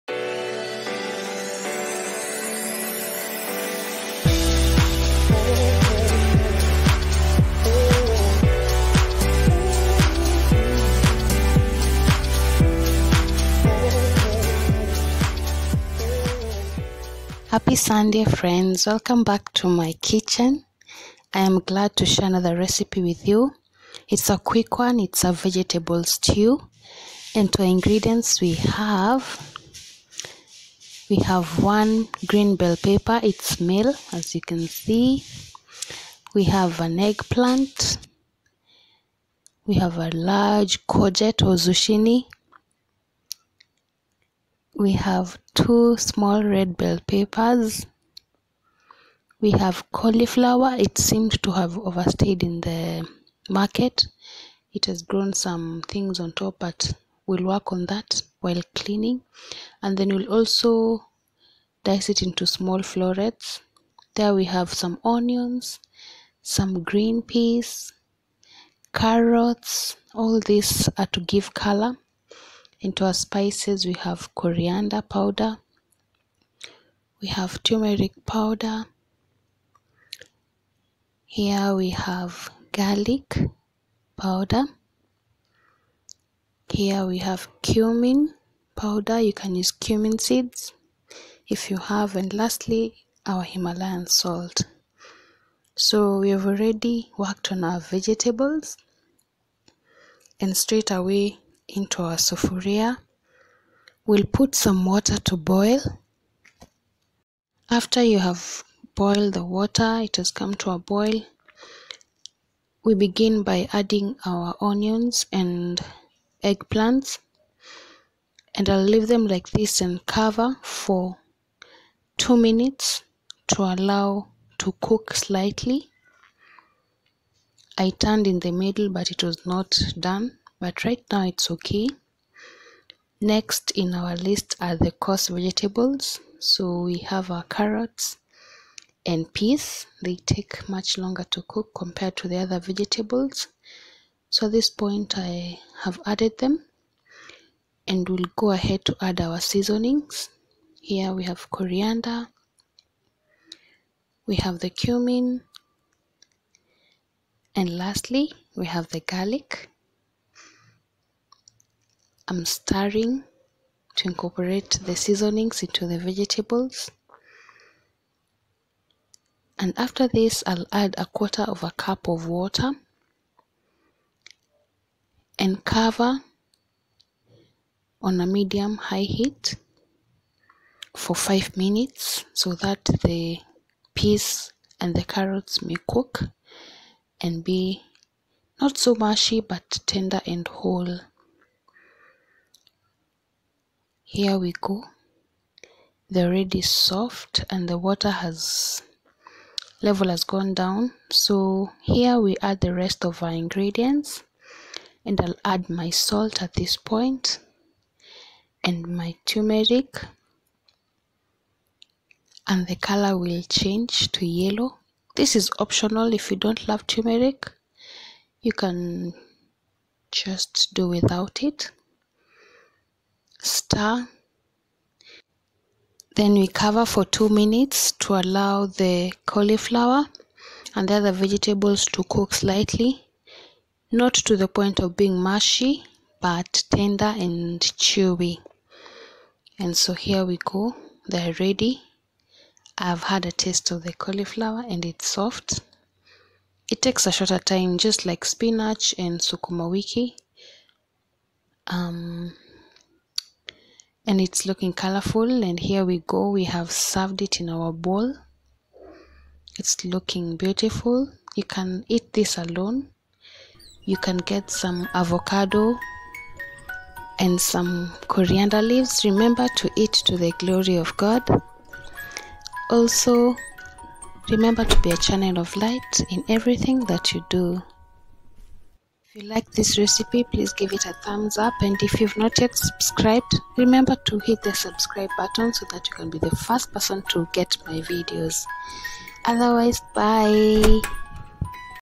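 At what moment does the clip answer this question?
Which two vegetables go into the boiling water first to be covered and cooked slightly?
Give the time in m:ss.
1:54.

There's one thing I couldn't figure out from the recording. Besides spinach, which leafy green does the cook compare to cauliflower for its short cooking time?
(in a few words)
sukuma wiki.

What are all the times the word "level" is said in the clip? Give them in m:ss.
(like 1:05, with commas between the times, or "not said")
3:19.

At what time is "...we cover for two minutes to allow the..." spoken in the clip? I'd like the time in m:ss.
3:46.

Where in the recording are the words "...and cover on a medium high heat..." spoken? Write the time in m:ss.
2:55.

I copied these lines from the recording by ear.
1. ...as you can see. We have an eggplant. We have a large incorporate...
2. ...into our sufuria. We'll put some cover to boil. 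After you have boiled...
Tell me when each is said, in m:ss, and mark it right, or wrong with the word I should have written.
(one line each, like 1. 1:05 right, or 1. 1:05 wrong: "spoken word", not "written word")
1. 0:34 wrong: "courgette", not "incorporate"
2. 1:41 wrong: "water", not "cover".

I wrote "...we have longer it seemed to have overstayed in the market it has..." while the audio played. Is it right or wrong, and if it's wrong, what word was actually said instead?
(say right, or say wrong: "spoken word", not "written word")
wrong: "cauliflower", not "longer".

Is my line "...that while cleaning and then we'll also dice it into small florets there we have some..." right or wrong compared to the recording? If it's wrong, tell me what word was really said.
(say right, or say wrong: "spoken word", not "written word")
right.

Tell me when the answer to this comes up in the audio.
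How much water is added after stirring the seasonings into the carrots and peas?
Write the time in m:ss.
2:50.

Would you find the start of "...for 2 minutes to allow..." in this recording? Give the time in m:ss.
2:00.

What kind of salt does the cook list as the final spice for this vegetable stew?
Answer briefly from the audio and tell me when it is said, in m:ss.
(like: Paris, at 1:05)
Himalayan salt, at 1:33.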